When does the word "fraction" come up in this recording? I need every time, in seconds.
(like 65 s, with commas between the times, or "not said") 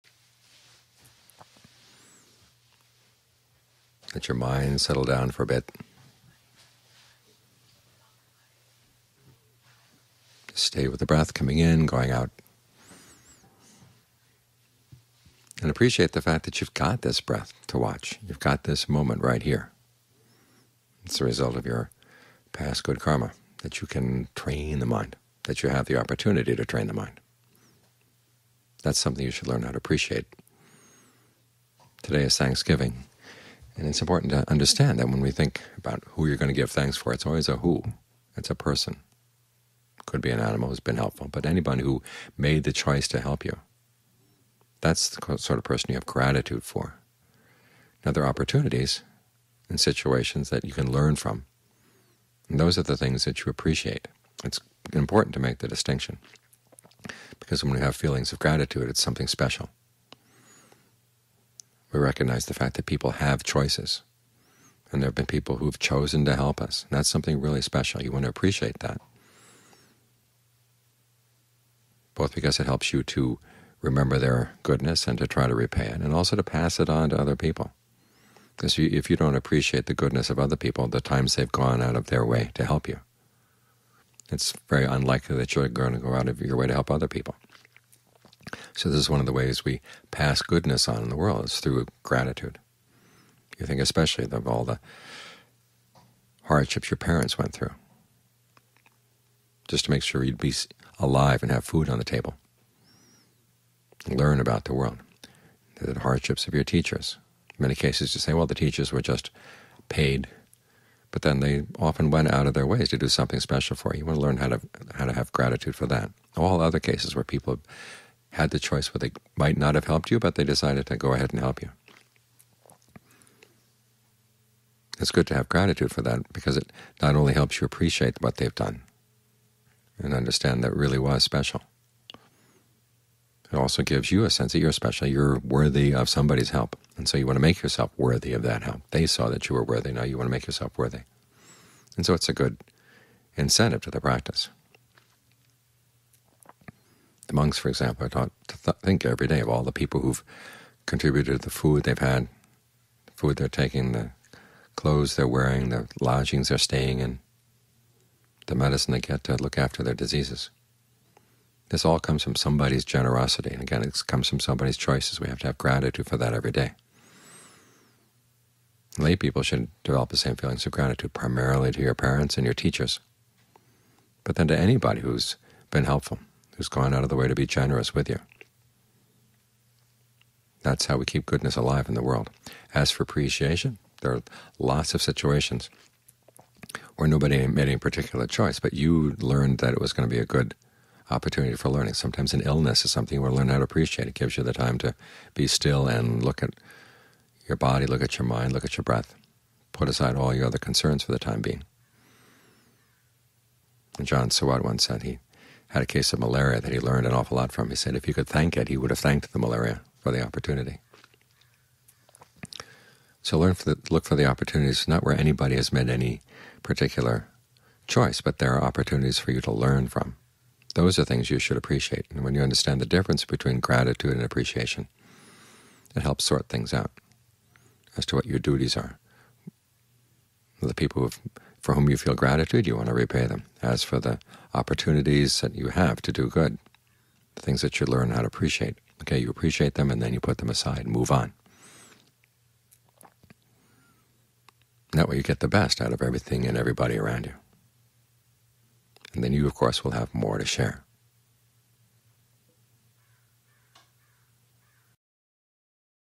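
not said.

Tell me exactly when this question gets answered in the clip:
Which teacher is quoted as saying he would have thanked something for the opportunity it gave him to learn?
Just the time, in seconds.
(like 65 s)
203 s.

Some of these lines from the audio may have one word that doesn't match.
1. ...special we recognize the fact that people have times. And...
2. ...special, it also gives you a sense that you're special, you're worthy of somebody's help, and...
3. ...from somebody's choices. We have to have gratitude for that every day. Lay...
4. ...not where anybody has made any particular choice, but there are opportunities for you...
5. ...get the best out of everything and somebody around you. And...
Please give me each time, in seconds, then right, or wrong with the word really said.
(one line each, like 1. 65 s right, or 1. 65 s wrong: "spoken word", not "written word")
1. 59 s wrong: "choices", not "times"
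2. 131 s right
3. 164 s right
4. 214 s right
5. 245 s wrong: "everybody", not "somebody".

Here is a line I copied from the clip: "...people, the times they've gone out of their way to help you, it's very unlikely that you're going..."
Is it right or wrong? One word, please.
right.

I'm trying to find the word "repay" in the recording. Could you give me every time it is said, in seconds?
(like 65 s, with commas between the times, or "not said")
75 s, 232 s.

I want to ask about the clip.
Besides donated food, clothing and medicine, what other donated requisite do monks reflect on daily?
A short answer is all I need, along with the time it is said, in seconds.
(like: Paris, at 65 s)
Lodgings, at 156 s.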